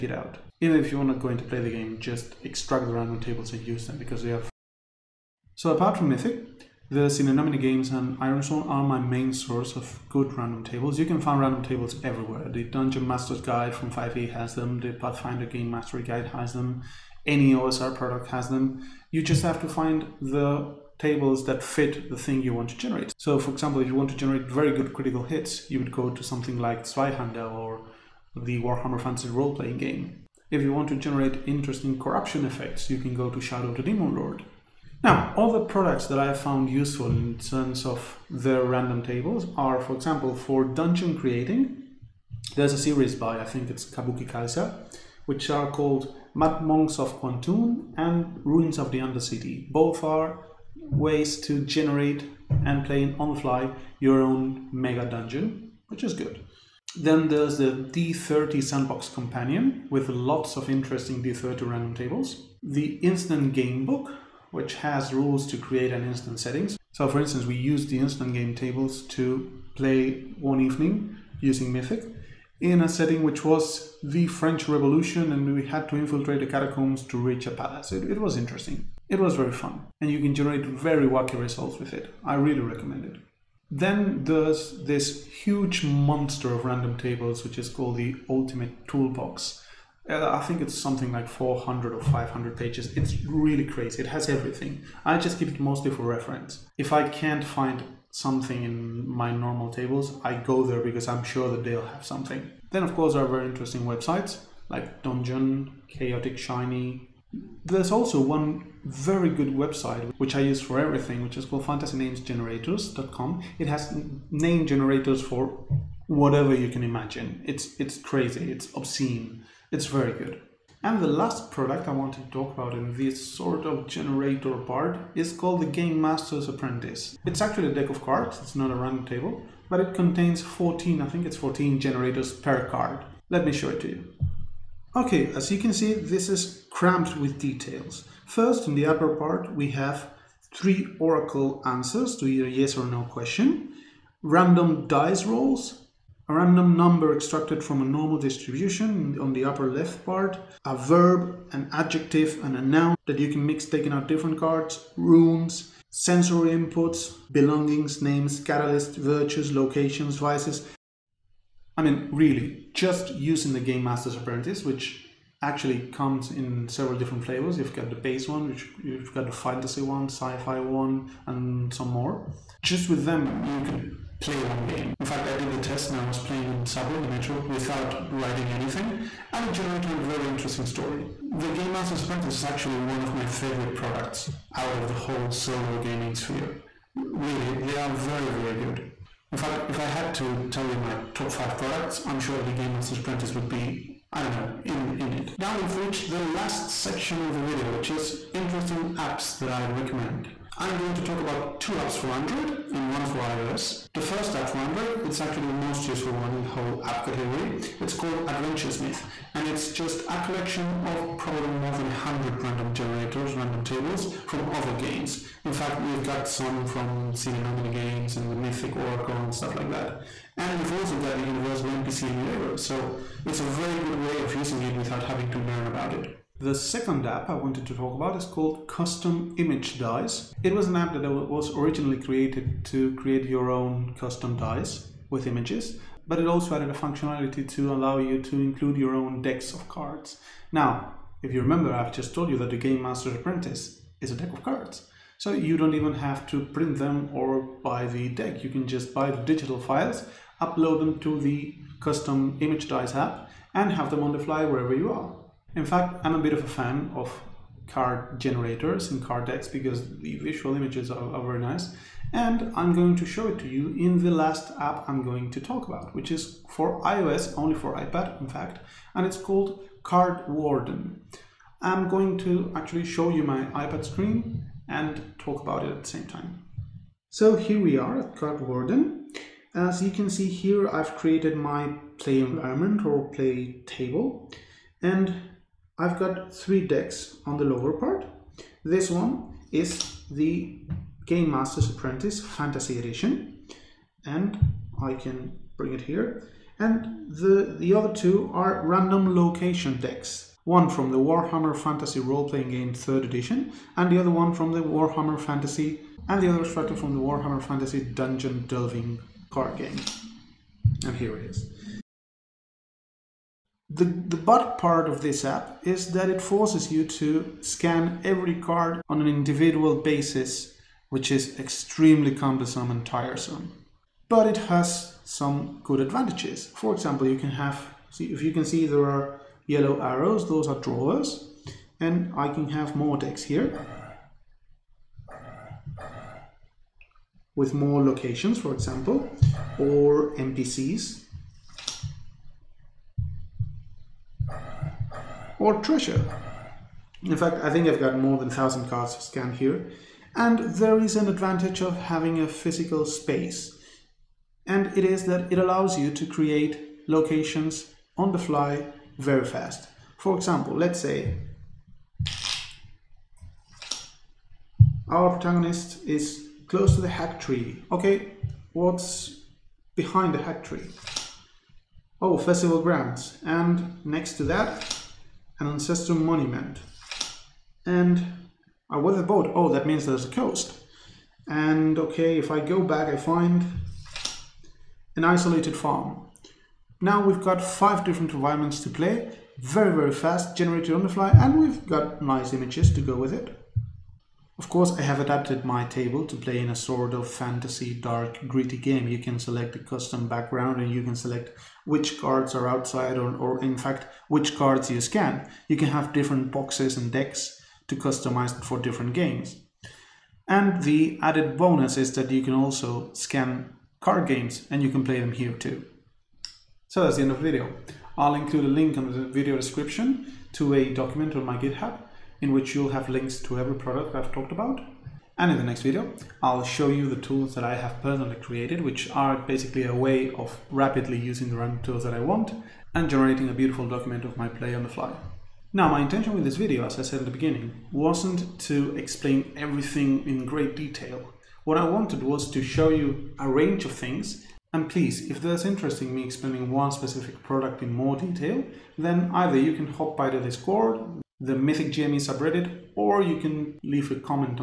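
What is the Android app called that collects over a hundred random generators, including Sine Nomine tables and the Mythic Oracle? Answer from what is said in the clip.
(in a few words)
Adventure Smith.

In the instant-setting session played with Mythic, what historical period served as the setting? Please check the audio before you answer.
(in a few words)
The French Revolution.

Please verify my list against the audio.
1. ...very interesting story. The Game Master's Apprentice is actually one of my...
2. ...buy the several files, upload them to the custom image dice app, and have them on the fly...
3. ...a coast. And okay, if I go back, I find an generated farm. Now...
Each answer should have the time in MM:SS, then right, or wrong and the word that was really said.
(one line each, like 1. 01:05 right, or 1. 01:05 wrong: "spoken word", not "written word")
1. 03:00 right
2. 04:08 wrong: "digital", not "several"
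3. 06:20 wrong: "isolated", not "generated".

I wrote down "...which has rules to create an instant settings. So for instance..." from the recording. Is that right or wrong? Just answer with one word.
right.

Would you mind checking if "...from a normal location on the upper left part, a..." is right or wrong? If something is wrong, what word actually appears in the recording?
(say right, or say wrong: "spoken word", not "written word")
wrong: "distribution", not "location".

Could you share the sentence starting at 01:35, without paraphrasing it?
I just keep it mostly for reference.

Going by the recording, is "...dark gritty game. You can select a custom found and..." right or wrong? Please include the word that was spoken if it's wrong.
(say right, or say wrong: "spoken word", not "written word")
wrong: "background", not "found".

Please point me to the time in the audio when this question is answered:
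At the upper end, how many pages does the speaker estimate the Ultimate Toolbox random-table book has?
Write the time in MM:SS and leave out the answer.
01:32.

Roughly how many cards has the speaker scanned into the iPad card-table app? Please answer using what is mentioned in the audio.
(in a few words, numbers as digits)
More than 1000.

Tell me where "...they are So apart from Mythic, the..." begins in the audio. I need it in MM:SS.
00:04.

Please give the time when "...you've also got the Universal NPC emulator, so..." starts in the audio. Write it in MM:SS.
03:40.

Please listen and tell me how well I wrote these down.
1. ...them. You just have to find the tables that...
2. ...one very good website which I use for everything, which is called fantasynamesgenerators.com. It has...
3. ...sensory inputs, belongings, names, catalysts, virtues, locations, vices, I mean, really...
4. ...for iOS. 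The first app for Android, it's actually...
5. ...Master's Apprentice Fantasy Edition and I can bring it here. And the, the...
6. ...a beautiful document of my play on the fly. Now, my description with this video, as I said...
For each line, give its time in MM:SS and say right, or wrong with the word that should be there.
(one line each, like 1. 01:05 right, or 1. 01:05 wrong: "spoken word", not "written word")
1. 00:18 right
2. 01:48 right
3. 02:35 right
4. 03:23 right
5. 04:51 right
6. 07:13 wrong: "intention", not "description".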